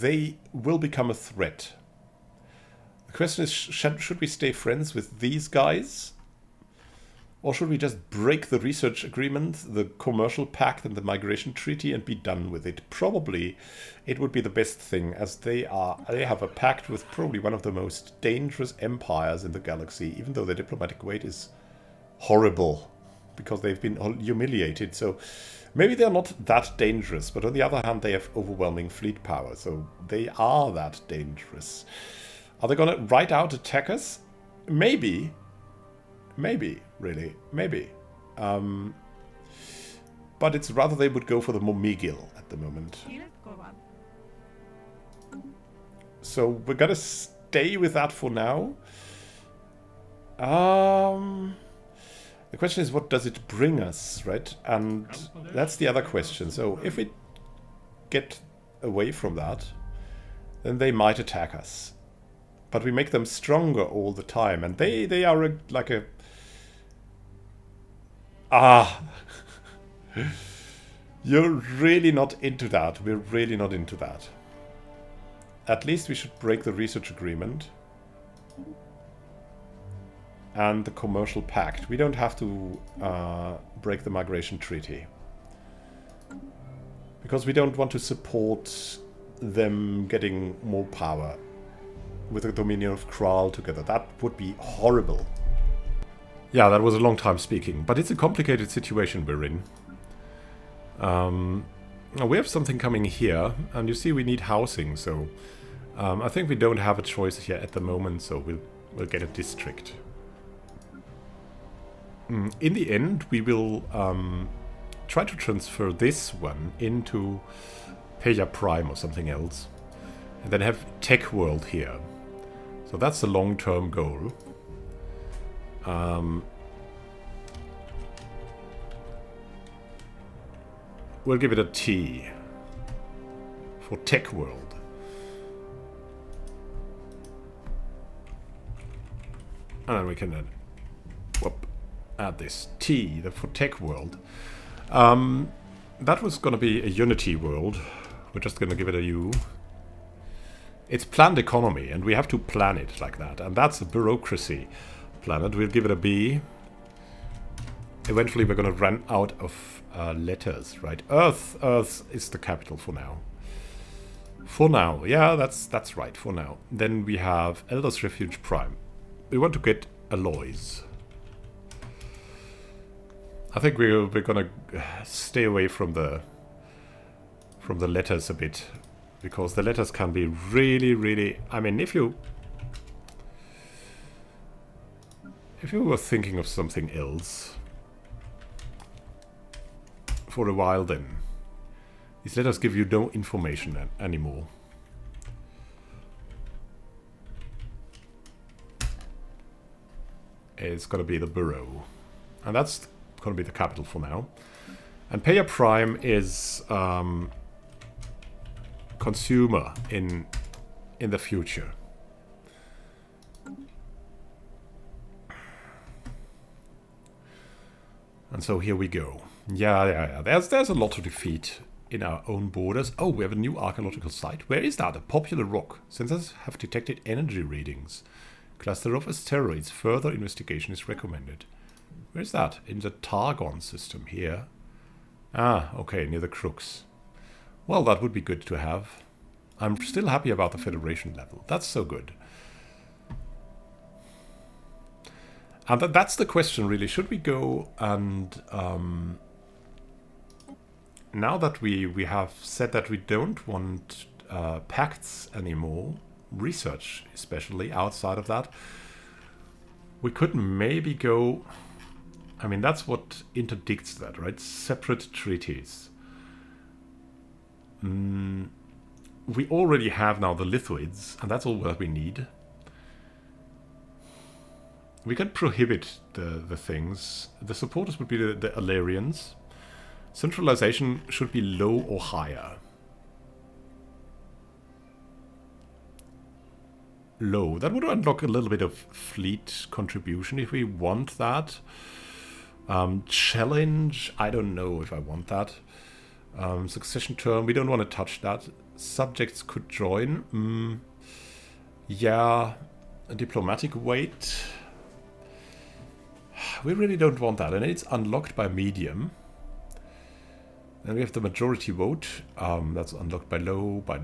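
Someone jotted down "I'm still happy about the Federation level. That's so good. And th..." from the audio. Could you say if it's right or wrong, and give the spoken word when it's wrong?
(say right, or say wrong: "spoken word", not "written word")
right.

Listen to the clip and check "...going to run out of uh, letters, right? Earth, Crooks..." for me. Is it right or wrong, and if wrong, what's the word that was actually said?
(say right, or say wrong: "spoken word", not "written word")
wrong: "Earth", not "Crooks".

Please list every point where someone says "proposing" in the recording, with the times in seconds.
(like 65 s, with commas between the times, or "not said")
not said.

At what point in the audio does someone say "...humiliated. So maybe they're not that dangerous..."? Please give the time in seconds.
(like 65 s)
24 s.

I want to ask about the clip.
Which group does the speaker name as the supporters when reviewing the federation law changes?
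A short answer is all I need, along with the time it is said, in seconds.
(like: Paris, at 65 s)
Illyrians, at 278 s.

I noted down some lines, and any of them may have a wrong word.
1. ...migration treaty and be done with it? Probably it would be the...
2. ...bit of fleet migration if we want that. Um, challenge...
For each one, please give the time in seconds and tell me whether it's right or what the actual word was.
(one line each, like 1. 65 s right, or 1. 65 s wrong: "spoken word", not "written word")
1. 11 s right
2. 288 s wrong: "contribution", not "migration".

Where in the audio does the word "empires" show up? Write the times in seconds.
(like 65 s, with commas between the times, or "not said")
18 s.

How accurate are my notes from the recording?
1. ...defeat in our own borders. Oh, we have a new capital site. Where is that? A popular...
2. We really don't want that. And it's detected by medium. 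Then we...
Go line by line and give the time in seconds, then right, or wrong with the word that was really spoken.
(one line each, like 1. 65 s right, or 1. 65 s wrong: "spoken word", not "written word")
1. 221 s wrong: "archaeological", not "capital"
2. 306 s wrong: "unlocked", not "detected".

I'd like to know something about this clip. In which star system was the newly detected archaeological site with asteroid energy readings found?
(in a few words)
Targon.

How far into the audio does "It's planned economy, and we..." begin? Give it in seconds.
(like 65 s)
150 s.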